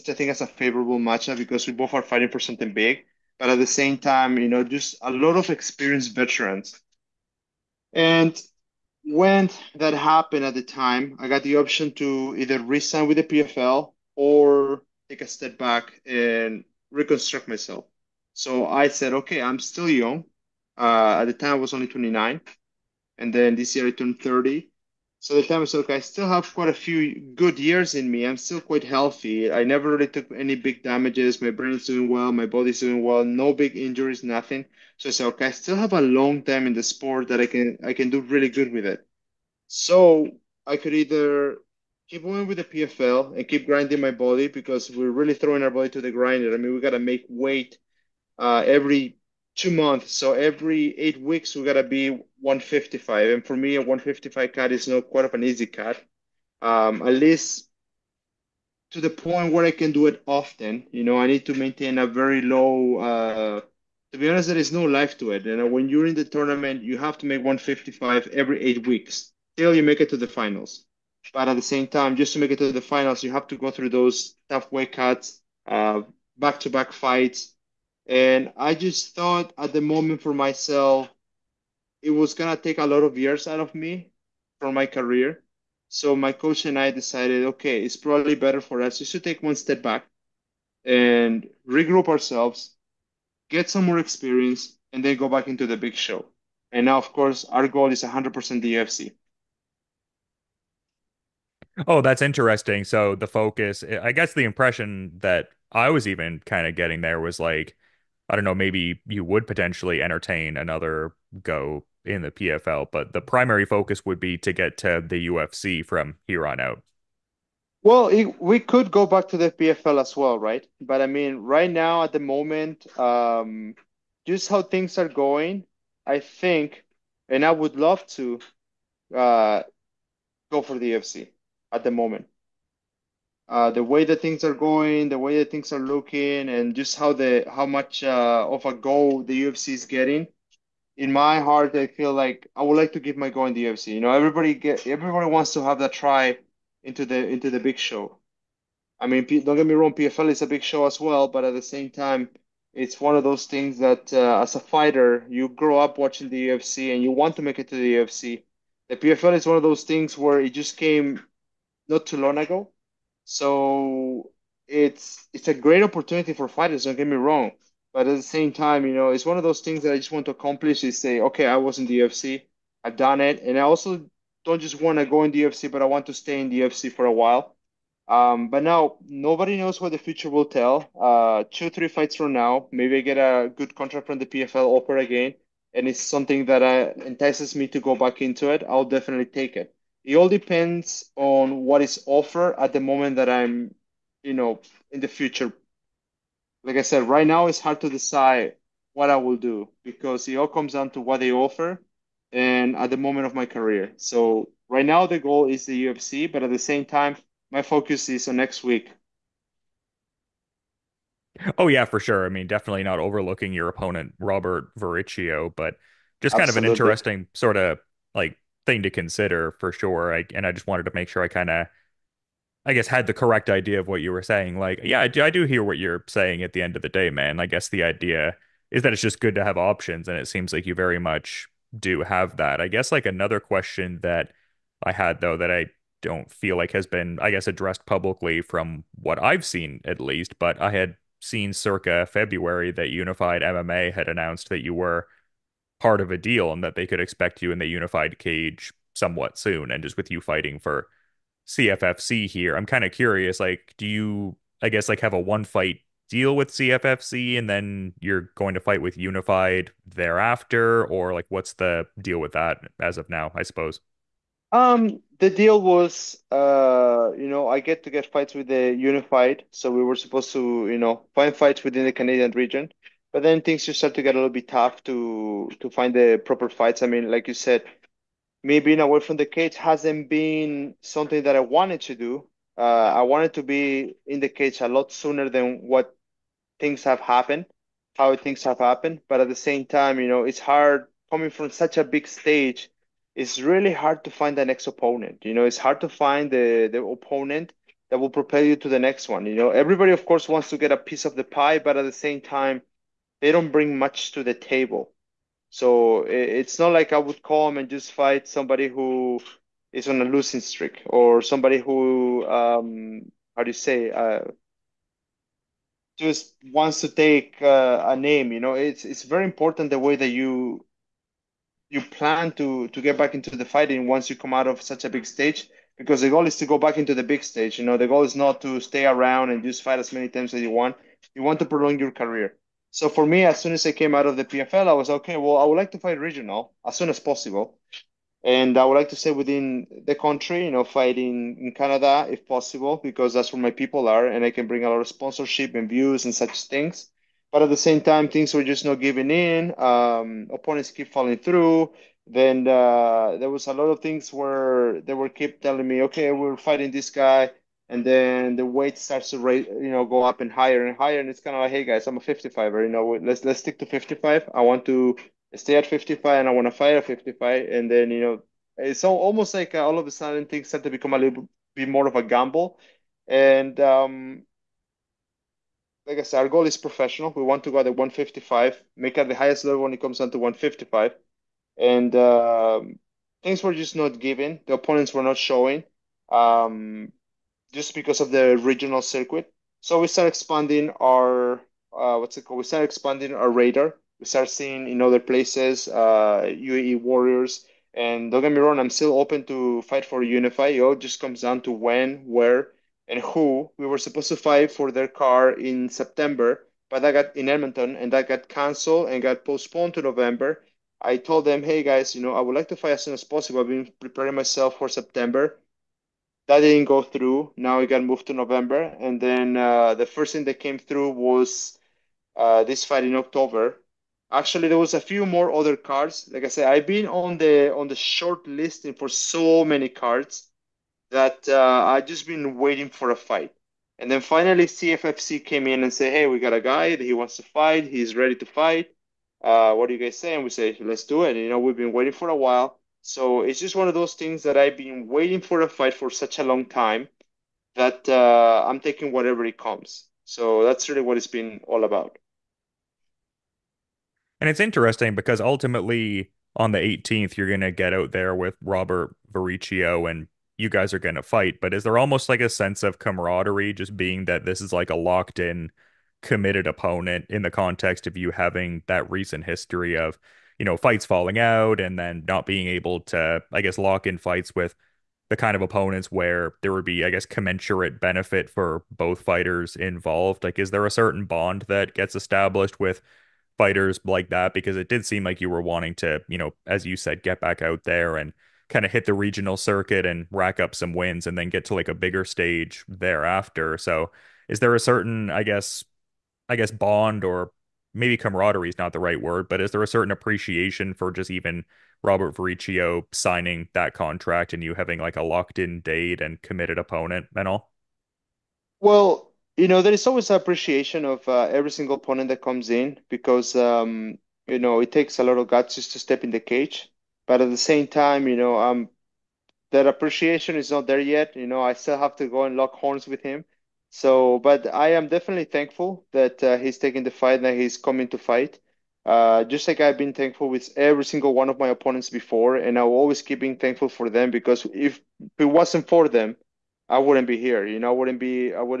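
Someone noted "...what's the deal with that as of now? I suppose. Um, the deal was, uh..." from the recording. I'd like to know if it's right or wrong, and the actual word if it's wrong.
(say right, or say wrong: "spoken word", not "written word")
right.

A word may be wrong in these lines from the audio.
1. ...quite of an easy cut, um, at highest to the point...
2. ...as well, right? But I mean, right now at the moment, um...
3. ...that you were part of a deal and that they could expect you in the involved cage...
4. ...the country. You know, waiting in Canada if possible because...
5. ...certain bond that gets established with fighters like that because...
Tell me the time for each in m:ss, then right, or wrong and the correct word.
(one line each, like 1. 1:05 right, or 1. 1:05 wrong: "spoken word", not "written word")
1. 0:55 wrong: "least", not "highest"
2. 1:59 right
3. 4:04 wrong: "unified", not "involved"
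4. 5:39 wrong: "fighting", not "waiting"
5. 8:00 right.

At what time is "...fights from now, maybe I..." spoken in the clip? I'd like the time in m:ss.
3:01.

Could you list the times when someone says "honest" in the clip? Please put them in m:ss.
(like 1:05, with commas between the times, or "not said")
1:04.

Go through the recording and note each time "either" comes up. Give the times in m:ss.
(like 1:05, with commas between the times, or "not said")
0:12, 0:40.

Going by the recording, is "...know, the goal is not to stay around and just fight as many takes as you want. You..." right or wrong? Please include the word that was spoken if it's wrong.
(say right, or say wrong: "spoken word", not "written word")
wrong: "times", not "takes".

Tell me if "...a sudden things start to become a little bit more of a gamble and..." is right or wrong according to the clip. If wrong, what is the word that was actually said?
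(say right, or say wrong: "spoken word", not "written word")
right.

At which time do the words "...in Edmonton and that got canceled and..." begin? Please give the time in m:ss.
6:47.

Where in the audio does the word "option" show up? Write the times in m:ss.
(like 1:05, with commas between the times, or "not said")
0:11, 3:49.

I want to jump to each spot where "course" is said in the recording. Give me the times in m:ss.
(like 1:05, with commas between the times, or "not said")
1:37, 5:00.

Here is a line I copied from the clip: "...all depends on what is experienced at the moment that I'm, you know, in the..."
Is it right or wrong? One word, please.
wrong.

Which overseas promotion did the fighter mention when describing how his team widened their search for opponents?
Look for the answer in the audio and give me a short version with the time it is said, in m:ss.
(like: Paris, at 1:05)
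UAE Warriors, at 6:36.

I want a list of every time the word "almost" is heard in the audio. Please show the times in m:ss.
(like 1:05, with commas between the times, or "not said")
6:08, 7:41.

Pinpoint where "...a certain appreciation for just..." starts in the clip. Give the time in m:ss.
8:19.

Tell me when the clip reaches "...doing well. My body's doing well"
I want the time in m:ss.
0:31.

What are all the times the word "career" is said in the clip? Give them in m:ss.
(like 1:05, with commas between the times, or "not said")
1:24, 3:23, 5:31.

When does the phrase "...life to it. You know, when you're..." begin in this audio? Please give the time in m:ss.
1:04.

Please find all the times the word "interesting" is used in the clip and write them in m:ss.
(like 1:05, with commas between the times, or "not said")
1:42, 3:36, 7:34.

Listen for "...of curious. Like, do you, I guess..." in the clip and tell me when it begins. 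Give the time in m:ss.
4:12.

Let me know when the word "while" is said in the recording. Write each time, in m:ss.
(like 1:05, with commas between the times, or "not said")
2:57, 7:22.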